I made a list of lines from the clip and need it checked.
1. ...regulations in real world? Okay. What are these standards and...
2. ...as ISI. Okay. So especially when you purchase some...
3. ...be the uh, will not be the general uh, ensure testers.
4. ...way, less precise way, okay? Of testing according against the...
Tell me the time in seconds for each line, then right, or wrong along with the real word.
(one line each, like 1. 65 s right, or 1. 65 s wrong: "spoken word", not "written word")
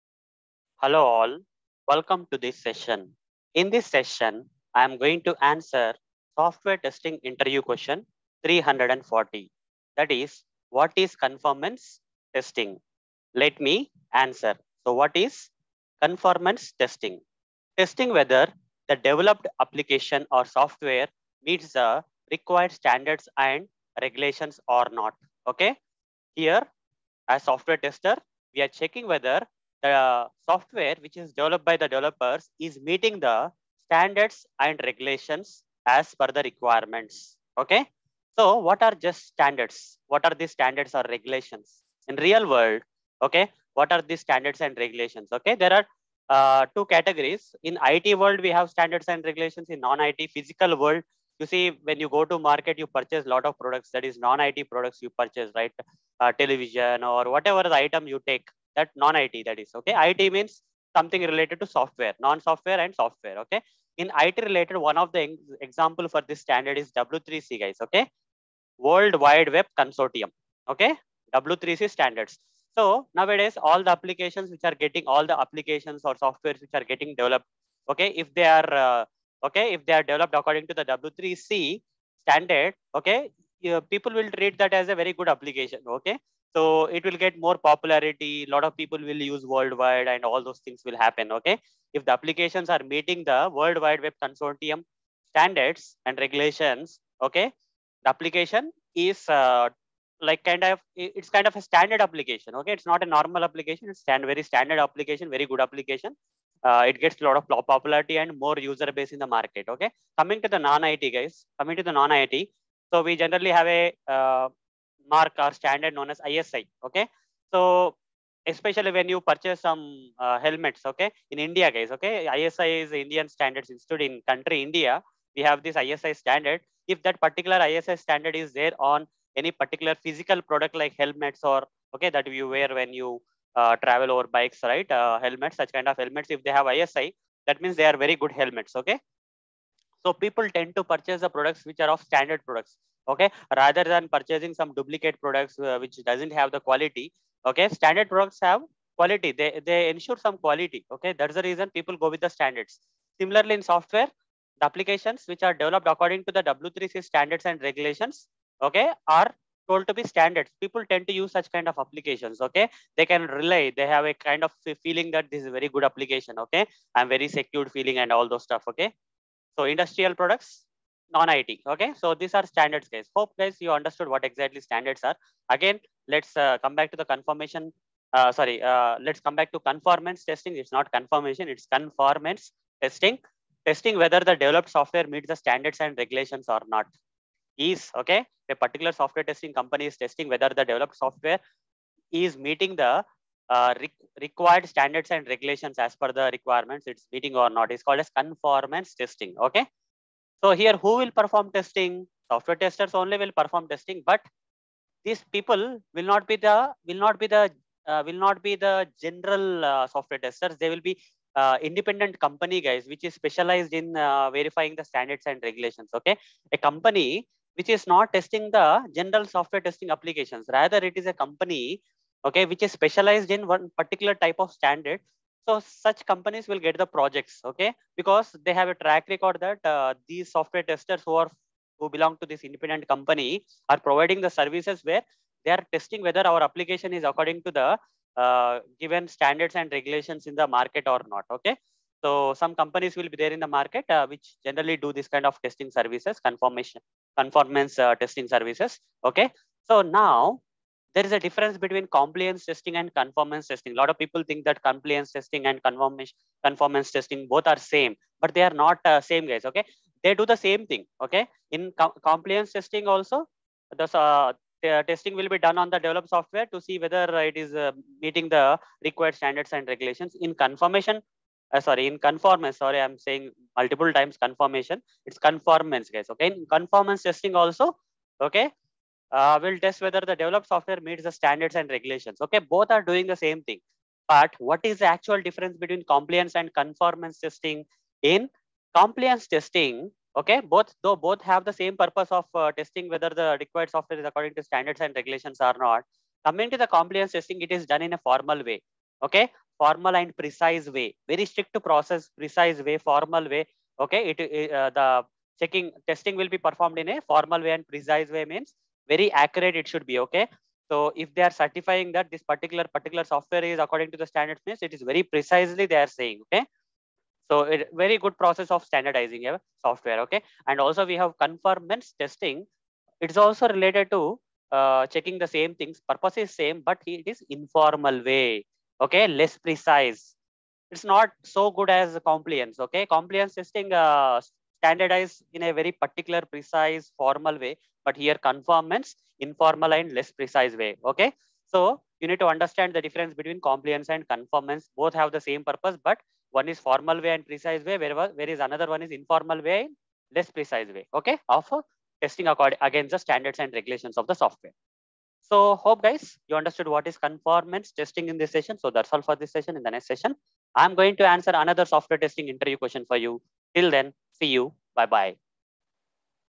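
1. 41 s right
2. 116 s right
3. 207 s wrong: "software", not "ensure"
4. 349 s right.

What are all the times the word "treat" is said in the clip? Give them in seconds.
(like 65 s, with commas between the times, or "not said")
84 s.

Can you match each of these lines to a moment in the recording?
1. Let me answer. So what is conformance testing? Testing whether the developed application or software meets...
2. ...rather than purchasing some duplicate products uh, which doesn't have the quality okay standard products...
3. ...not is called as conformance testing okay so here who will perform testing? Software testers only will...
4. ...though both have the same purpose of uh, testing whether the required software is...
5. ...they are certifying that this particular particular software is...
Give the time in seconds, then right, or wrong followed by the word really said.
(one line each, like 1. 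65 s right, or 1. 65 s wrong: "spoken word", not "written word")
1. 13 s right
2. 143 s right
3. 197 s right
4. 290 s right
5. 311 s right.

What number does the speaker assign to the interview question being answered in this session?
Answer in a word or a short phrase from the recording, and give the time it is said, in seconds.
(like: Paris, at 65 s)
340, at 8 s.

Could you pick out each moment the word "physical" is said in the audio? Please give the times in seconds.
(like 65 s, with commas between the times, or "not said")
50 s, 129 s.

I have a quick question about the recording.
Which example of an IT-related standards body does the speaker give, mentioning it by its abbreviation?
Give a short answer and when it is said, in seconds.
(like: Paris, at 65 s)
W3C, at 66 s.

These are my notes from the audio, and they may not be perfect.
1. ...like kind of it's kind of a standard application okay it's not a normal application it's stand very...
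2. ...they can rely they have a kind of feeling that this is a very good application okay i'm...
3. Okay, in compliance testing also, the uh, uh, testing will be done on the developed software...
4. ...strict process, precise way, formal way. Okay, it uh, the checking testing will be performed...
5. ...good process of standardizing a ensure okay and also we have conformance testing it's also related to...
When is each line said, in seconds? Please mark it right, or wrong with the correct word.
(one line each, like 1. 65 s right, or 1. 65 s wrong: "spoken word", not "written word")
1. 100 s right
2. 162 s right
3. 261 s right
4. 301 s right
5. 317 s wrong: "software", not "ensure".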